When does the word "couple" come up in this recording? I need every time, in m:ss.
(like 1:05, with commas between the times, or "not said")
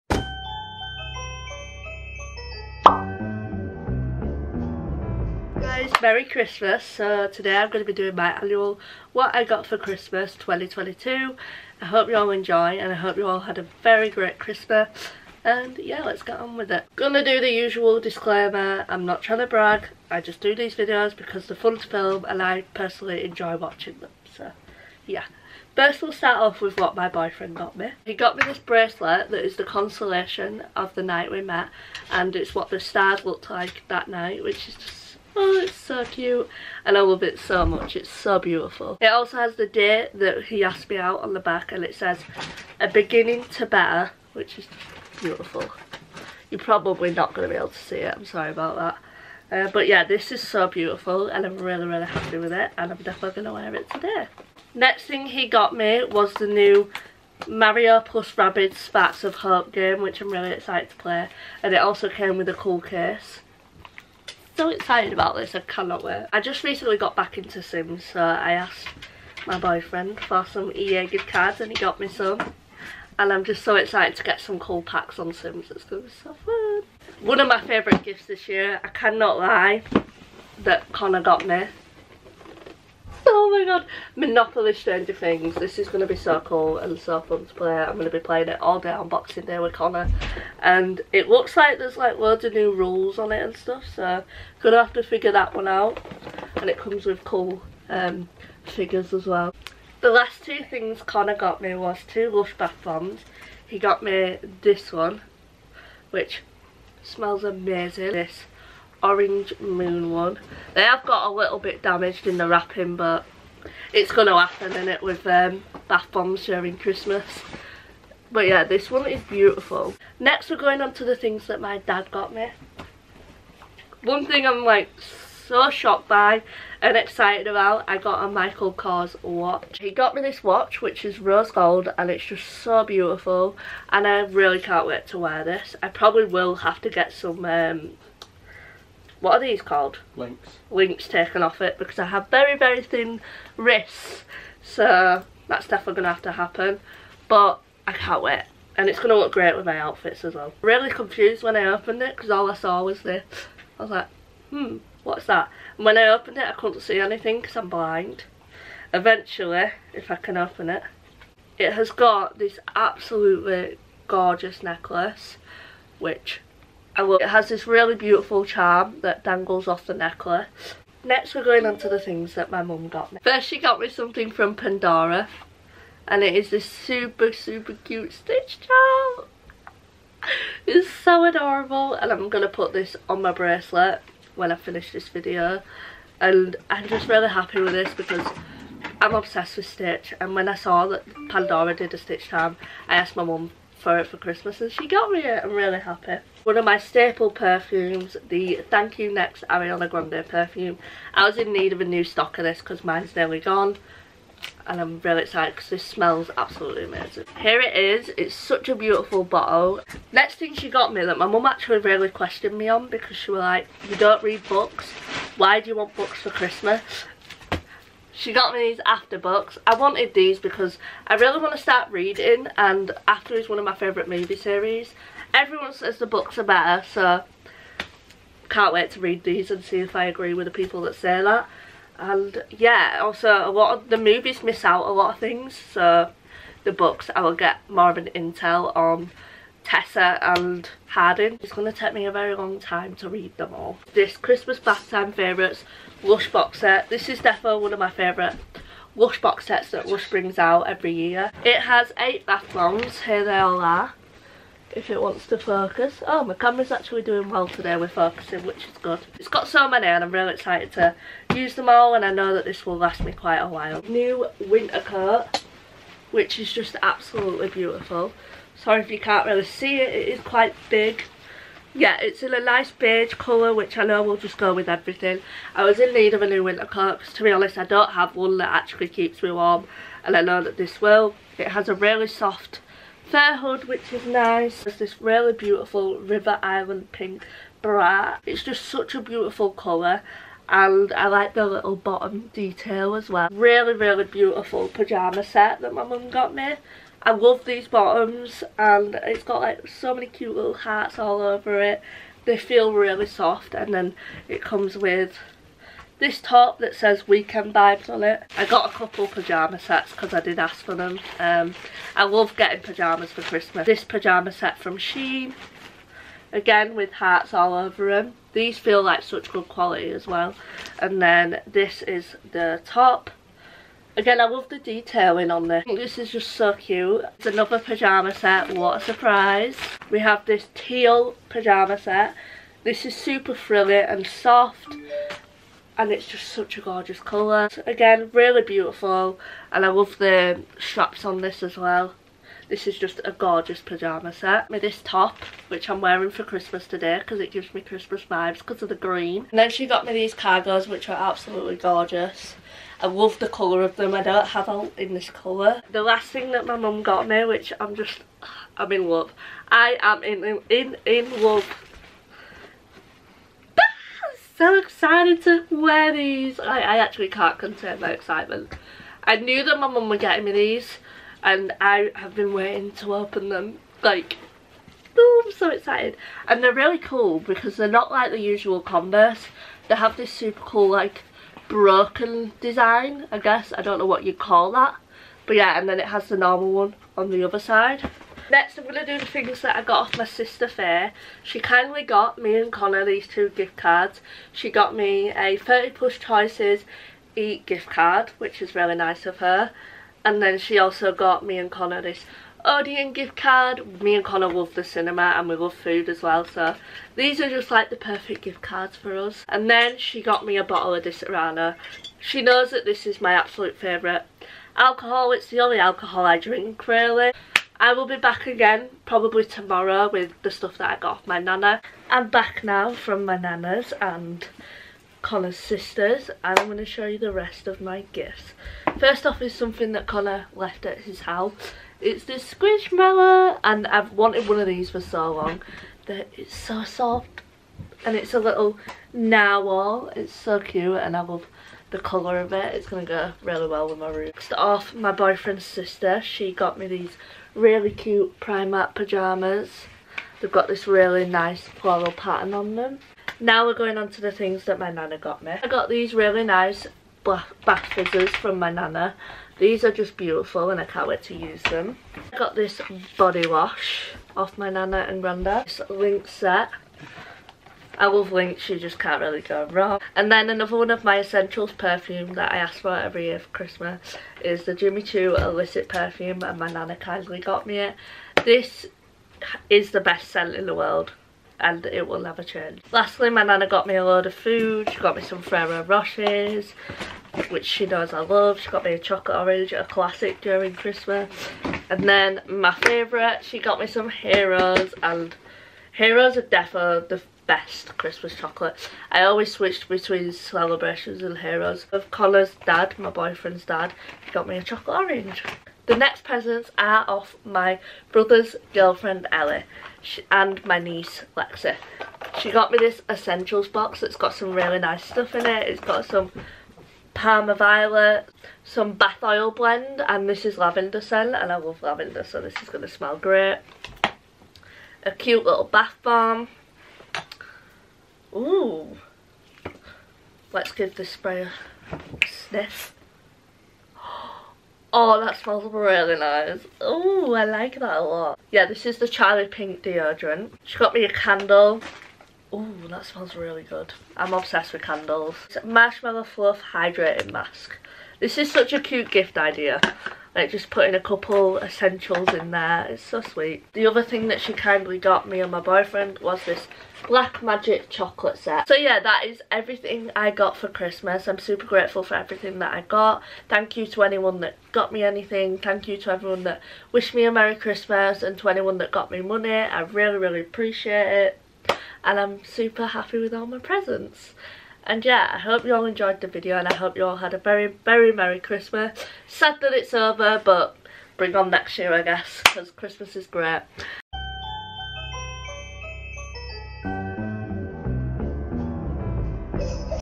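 5:08, 9:10.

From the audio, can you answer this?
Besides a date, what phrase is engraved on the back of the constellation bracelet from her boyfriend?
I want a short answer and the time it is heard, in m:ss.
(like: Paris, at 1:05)
A beginning to better, at 0:42.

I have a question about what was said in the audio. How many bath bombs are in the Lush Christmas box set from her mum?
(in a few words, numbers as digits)
8.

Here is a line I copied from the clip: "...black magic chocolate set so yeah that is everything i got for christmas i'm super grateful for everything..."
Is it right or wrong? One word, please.
right.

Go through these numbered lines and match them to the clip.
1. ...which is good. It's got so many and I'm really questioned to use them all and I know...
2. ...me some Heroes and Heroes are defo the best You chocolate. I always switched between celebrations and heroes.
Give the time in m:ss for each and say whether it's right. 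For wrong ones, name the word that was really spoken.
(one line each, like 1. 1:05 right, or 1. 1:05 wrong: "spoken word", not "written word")
1. 4:18 wrong: "excited", not "questioned"
2. 8:13 wrong: "Christmas", not "You".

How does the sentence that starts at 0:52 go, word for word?
And I'm definitely going to wear it today.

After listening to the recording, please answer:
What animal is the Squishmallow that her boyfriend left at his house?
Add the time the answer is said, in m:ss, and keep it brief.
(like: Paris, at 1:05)
Narwhal, at 7:18.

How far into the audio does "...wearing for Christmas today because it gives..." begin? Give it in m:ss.
5:45.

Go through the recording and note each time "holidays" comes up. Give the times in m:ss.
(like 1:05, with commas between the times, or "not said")
not said.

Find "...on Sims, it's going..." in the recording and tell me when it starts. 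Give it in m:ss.
1:15.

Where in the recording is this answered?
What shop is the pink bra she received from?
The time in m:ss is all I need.
4:45.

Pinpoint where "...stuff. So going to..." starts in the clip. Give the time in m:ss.
1:33.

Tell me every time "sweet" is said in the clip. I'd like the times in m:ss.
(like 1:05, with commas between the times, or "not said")
9:13.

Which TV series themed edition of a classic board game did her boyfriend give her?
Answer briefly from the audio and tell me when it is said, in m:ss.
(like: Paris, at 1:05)
Stranger Things, at 1:24.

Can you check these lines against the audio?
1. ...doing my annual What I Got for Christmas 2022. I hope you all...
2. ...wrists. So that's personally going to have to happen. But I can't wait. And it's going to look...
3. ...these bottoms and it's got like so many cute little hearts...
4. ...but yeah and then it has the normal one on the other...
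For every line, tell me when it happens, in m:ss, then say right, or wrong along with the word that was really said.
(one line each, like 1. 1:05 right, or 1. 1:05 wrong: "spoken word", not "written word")
1. 0:07 right
2. 2:23 wrong: "definitely", not "personally"
3. 4:57 right
4. 6:25 right.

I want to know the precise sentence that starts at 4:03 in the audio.
This Christmas bath time favourites Lush box set.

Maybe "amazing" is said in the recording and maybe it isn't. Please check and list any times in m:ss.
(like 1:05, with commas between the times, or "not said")
1:47, 3:26.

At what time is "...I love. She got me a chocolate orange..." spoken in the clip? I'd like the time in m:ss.
8:07.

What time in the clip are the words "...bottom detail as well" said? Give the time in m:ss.
4:51.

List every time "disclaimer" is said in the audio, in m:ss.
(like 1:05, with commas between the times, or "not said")
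0:17.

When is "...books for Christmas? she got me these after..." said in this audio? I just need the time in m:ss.
3:35.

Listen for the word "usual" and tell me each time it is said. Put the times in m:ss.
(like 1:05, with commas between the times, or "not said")
0:17, 6:18.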